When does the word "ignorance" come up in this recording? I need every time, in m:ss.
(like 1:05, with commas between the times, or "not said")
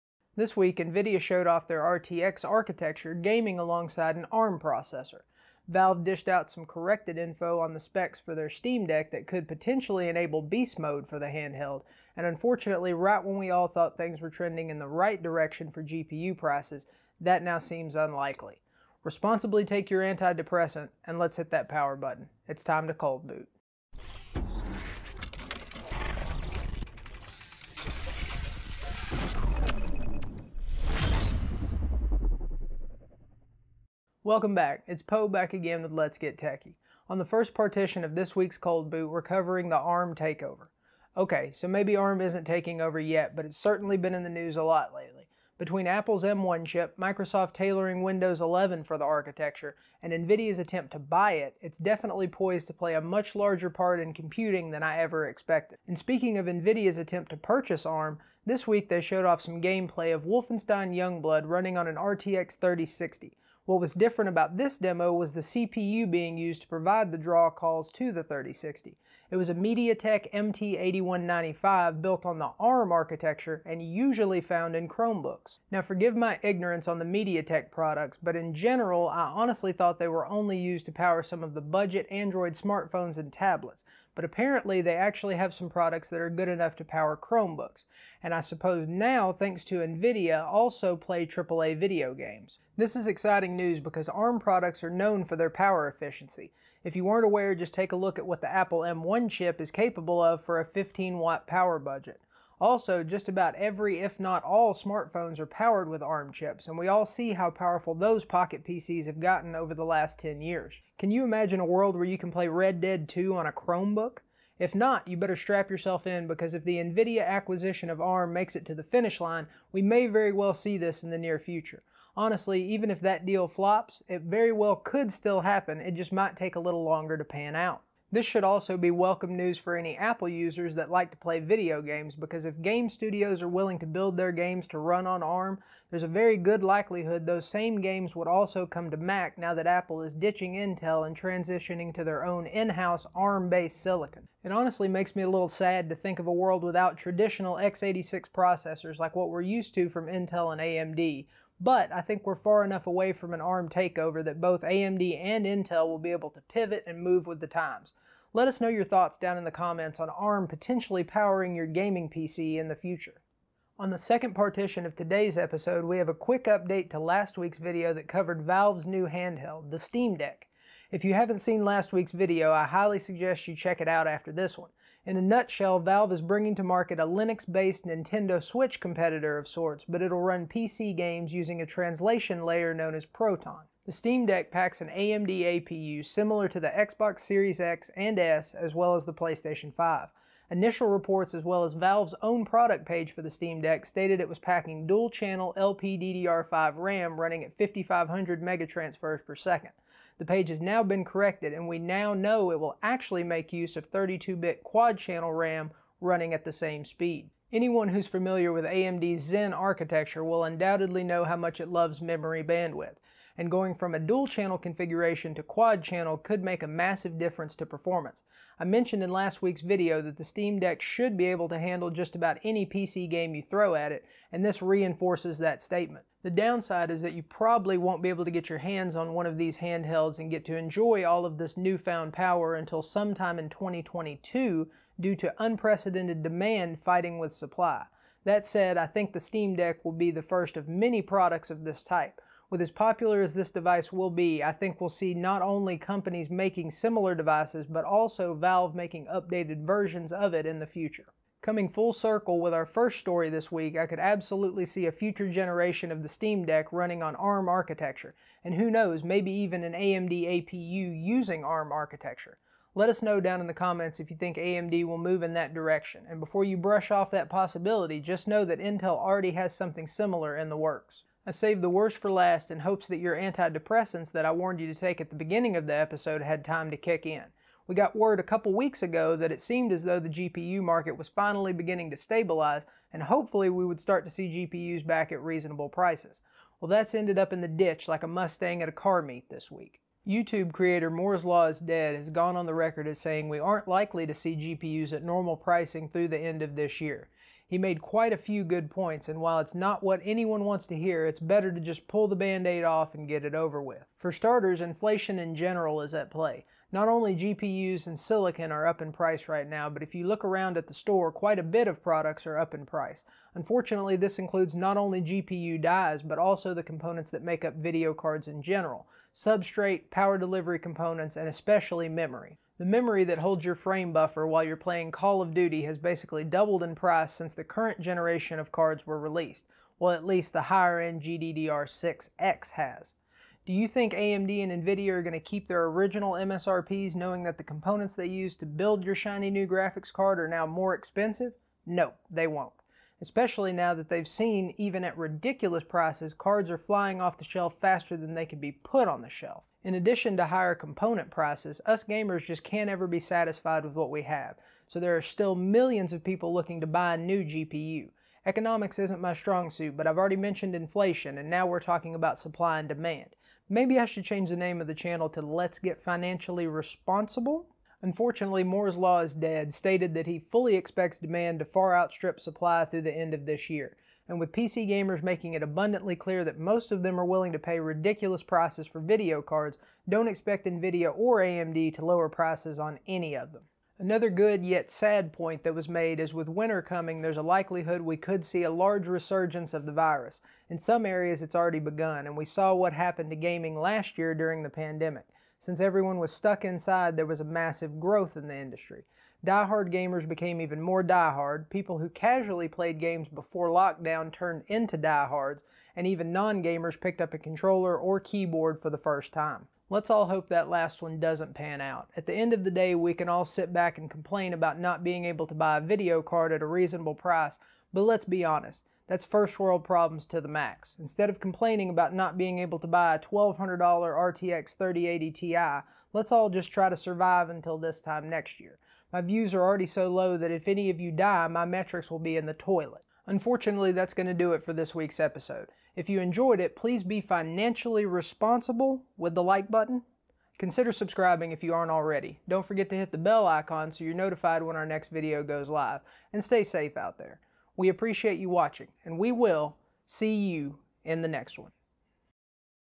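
1:16.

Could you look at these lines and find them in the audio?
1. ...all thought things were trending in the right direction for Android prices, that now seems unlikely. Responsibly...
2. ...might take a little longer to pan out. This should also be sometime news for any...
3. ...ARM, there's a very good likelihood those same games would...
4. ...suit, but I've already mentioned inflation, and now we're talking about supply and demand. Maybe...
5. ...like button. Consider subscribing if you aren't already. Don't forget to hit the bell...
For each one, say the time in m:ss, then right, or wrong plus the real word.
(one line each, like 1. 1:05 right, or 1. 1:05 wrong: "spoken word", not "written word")
1. 0:13 wrong: "GPU", not "Android"
2. 2:06 wrong: "welcome", not "sometime"
3. 2:15 right
4. 5:59 right
5. 7:19 right.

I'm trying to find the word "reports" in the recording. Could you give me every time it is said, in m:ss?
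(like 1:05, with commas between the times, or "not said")
3:10.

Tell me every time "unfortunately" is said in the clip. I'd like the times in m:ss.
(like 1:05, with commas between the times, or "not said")
0:12, 5:13, 6:07, 7:13.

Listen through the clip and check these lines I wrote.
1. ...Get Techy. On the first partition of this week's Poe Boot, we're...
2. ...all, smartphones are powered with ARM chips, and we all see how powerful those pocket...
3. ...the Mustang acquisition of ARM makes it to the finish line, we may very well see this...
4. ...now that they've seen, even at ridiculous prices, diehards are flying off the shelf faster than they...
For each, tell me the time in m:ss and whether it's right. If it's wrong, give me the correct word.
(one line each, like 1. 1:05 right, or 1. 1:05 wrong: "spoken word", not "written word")
1. 0:36 wrong: "Cold", not "Poe"
2. 1:44 right
3. 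1:56 wrong: "NVIDIA", not "Mustang"
4. 5:43 wrong: "cards", not "diehards".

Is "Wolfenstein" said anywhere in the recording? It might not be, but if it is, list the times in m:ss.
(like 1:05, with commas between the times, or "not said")
1:00.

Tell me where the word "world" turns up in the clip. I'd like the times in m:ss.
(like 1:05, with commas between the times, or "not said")
1:51, 2:26, 6:59.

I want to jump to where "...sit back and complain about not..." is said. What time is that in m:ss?
6:53.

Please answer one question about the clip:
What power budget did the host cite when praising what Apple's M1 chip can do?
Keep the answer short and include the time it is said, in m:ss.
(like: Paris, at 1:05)
15 watts, at 1:40.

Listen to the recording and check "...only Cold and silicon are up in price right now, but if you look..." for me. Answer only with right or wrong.
wrong.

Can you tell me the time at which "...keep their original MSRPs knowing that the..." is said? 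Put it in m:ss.
5:35.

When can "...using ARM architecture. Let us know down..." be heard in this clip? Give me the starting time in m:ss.
4:21.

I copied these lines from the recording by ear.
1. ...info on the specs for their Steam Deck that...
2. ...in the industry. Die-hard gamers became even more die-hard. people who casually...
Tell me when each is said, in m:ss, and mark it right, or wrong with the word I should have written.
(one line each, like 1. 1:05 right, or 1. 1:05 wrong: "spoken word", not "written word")
1. 0:07 right
2. 6:38 right.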